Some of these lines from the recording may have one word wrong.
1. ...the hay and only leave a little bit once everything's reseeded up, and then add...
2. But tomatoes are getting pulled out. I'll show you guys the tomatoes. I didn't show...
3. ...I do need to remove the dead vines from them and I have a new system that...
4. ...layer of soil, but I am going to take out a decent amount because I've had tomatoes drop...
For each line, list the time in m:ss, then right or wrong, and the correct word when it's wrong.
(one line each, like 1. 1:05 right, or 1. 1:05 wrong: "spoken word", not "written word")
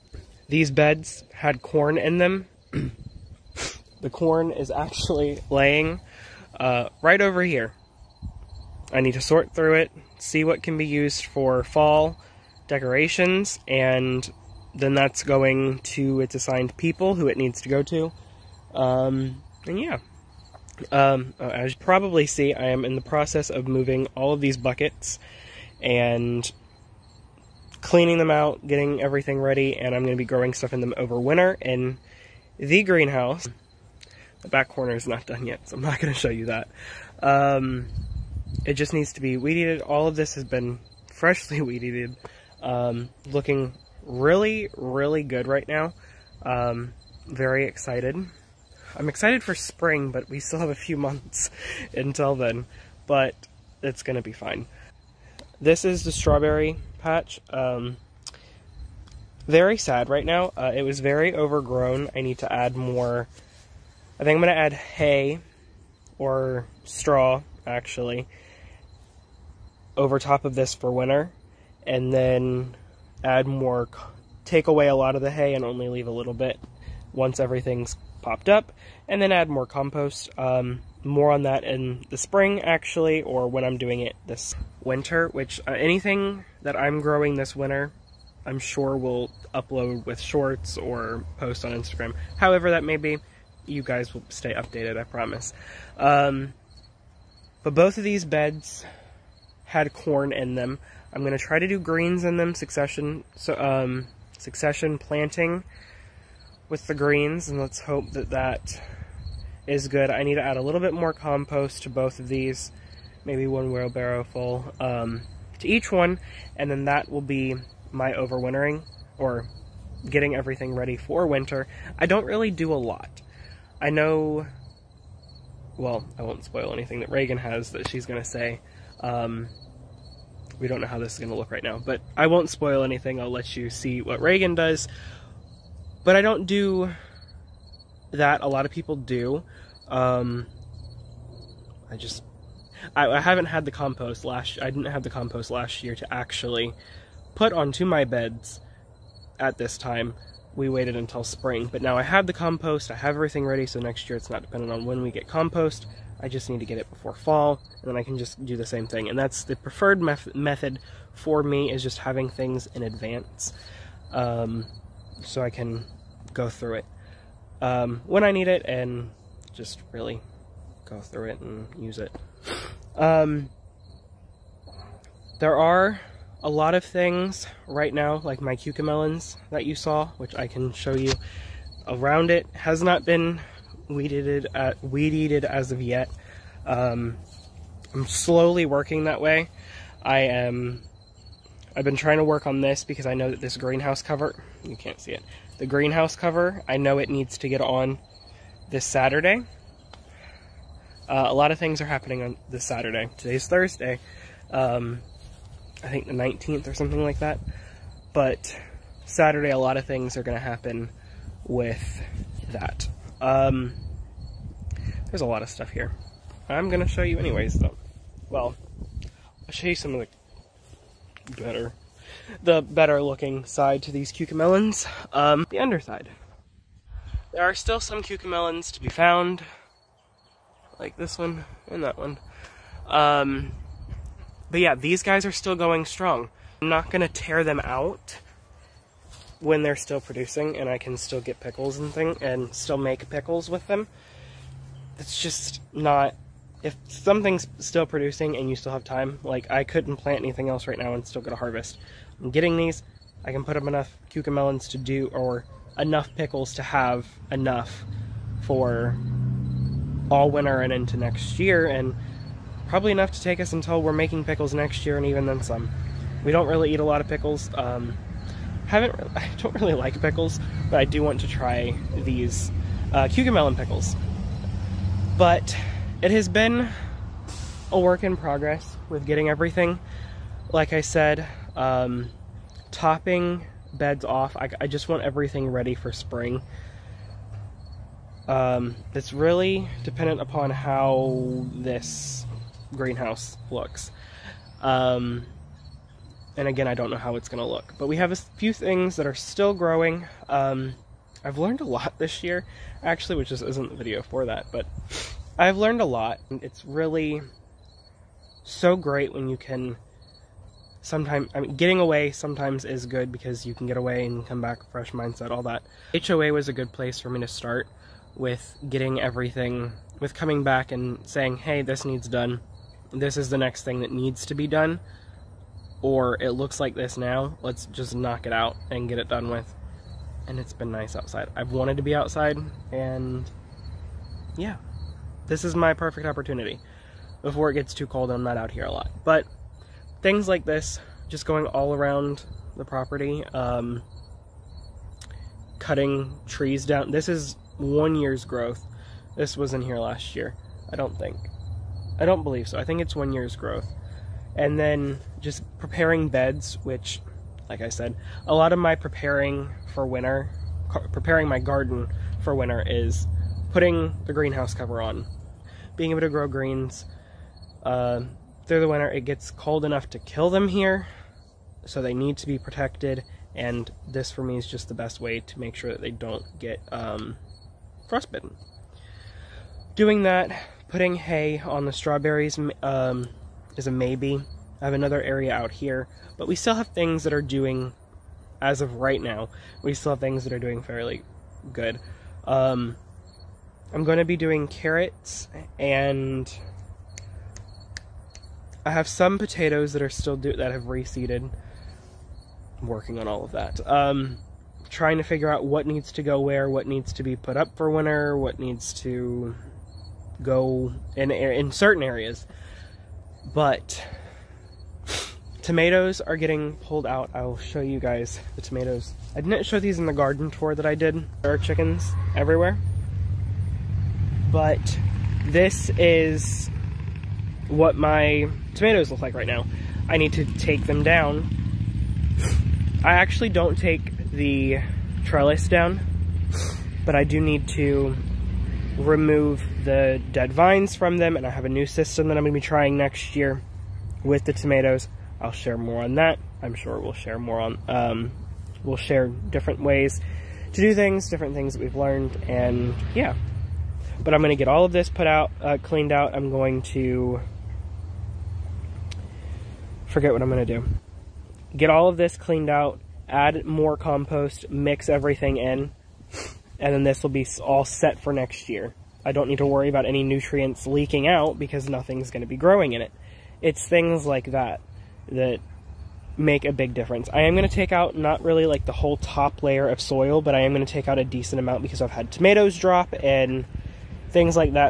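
1. 1:15 wrong: "popped", not "reseeded"
2. 6:53 right
3. 7:16 right
4. 7:59 right.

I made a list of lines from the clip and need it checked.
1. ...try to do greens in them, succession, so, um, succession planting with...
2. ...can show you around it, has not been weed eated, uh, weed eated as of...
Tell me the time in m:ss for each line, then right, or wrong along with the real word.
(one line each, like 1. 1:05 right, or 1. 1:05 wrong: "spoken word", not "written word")
1. 1:41 right
2. 3:00 right.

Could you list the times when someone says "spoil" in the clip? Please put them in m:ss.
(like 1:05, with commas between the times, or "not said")
2:06, 2:12.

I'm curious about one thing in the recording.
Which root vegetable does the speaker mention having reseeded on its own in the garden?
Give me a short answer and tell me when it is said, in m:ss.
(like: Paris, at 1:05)
potatoes, at 6:39.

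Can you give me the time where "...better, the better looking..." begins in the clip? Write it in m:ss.
3:41.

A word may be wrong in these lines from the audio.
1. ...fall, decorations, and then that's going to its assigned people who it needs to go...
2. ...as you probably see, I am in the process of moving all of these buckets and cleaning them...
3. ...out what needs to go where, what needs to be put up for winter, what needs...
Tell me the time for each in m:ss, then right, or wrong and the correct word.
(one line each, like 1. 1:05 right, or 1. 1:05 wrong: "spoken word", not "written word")
1. 0:11 right
2. 0:21 right
3. 6:45 right.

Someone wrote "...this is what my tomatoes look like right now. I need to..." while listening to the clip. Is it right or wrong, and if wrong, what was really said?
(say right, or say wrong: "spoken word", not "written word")
right.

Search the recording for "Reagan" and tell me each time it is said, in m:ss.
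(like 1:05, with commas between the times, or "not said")
2:07, 2:14.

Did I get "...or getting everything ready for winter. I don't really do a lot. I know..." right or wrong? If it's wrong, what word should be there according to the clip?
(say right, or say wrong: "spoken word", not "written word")
right.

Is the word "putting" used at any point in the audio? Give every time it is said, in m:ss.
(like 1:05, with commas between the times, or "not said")
6:03, 6:20.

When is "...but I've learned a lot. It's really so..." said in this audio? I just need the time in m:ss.
5:04.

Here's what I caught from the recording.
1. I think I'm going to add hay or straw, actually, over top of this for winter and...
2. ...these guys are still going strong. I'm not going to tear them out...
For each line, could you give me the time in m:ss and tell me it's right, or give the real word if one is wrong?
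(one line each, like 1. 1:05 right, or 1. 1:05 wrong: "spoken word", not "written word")
1. 1:04 right
2. 3:54 right.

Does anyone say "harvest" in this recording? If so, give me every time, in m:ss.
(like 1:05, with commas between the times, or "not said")
4:11.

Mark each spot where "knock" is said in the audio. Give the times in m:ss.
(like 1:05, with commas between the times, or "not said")
5:27.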